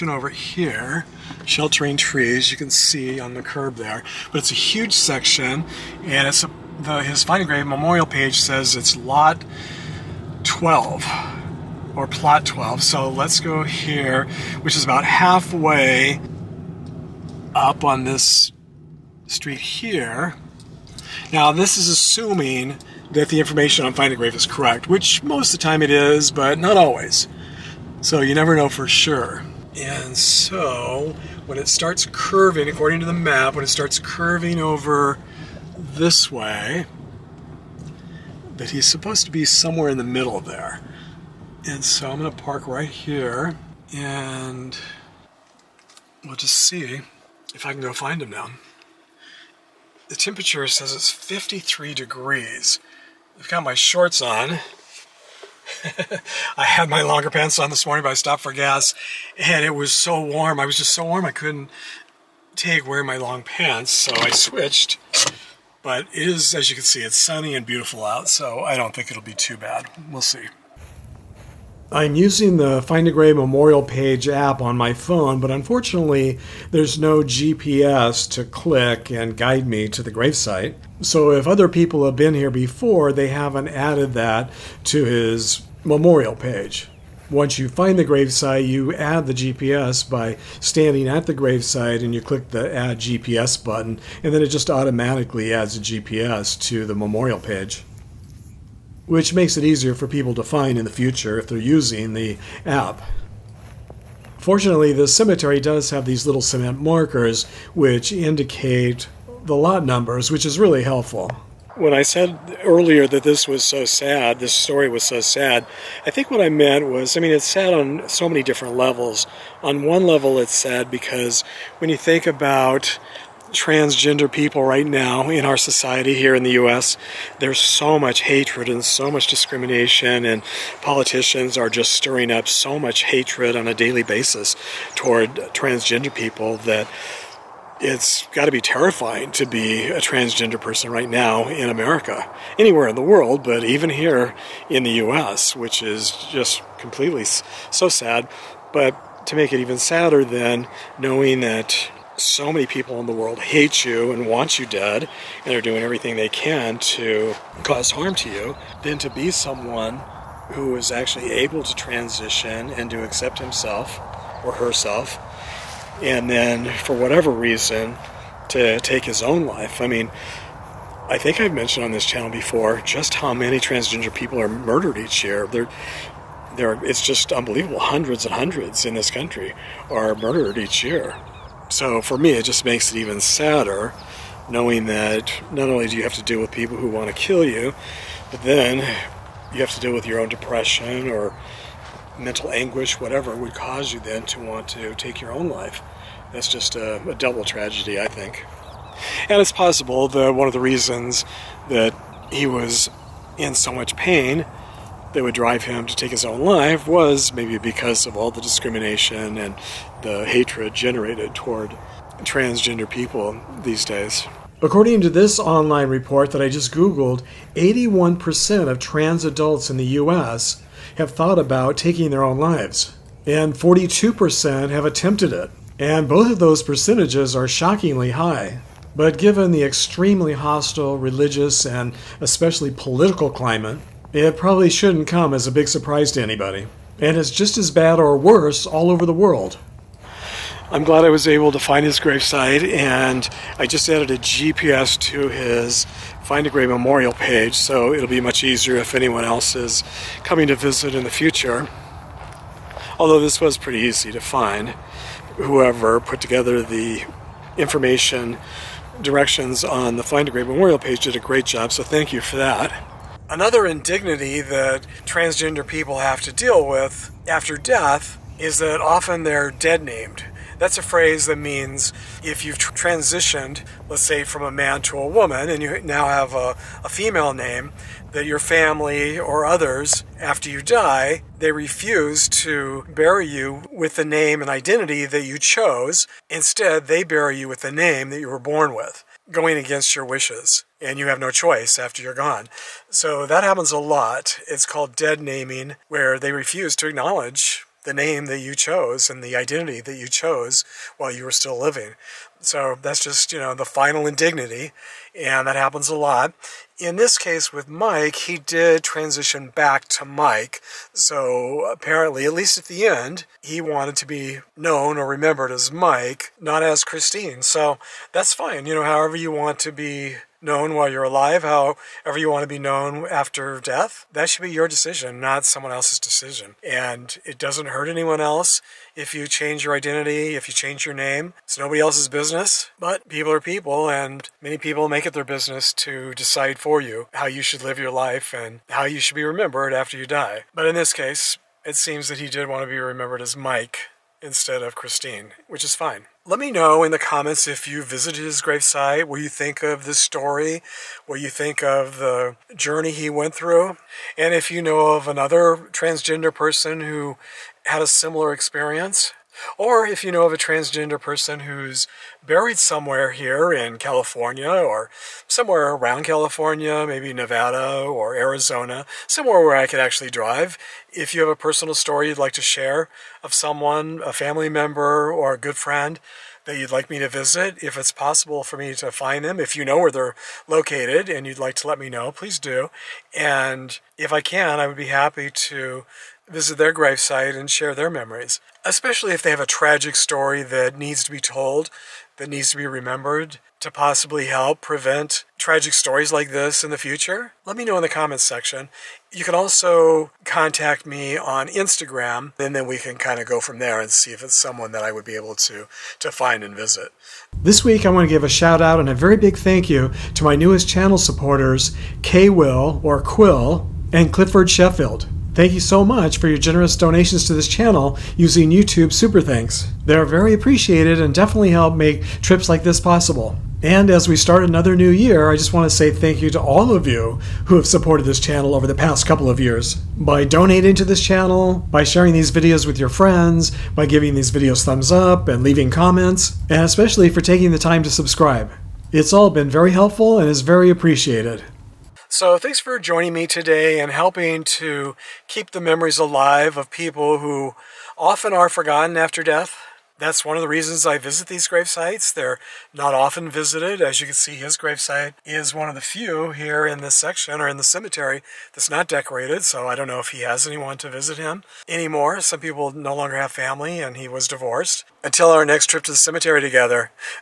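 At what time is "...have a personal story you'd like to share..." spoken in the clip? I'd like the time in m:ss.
6:11.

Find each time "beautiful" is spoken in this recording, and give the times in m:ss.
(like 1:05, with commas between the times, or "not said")
1:07.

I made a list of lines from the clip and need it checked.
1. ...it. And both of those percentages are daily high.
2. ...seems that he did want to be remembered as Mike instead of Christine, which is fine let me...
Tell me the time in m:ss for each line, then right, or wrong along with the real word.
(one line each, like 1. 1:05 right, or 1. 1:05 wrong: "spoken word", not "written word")
1. 3:45 wrong: "shockingly", not "daily"
2. 5:41 right.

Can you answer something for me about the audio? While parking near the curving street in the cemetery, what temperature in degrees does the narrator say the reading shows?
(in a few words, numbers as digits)
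53.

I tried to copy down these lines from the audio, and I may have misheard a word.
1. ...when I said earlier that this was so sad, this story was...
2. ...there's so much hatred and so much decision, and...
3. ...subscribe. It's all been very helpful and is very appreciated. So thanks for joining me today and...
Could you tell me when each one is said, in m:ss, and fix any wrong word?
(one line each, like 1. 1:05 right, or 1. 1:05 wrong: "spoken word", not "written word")
1. 1:51 right
2. 2:07 wrong: "discrimination", not "decision"
3. 7:17 right.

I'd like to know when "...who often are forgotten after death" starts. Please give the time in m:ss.
7:27.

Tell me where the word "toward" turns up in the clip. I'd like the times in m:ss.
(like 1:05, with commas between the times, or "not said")
2:14, 3:31.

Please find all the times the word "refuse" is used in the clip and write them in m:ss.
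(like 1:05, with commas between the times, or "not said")
4:41, 4:56.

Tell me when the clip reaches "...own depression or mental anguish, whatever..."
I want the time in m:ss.
3:10.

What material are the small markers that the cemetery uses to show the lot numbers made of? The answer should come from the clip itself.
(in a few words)
cement.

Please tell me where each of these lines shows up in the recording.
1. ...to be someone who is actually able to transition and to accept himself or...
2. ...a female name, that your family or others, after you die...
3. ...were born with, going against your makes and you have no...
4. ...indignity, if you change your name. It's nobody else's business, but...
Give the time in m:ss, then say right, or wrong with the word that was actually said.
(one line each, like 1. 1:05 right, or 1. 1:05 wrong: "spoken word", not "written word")
1. 2:38 right
2. 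4:36 right
3. 4:48 wrong: "wishes", not "makes"
4. 5:29 wrong: "identity", not "indignity".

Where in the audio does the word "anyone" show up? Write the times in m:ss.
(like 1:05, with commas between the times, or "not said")
4:08, 5:27, 7:40.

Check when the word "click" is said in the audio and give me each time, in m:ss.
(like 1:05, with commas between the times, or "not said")
1:18, 1:32.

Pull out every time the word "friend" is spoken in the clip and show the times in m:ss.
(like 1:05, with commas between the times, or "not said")
6:15, 7:12.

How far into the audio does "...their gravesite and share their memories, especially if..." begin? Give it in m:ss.
6:26.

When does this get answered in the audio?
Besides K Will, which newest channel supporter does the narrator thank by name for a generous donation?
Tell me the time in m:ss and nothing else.
6:54.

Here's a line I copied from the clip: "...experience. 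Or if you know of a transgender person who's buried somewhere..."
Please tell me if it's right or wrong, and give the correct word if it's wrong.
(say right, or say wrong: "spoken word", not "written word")
right.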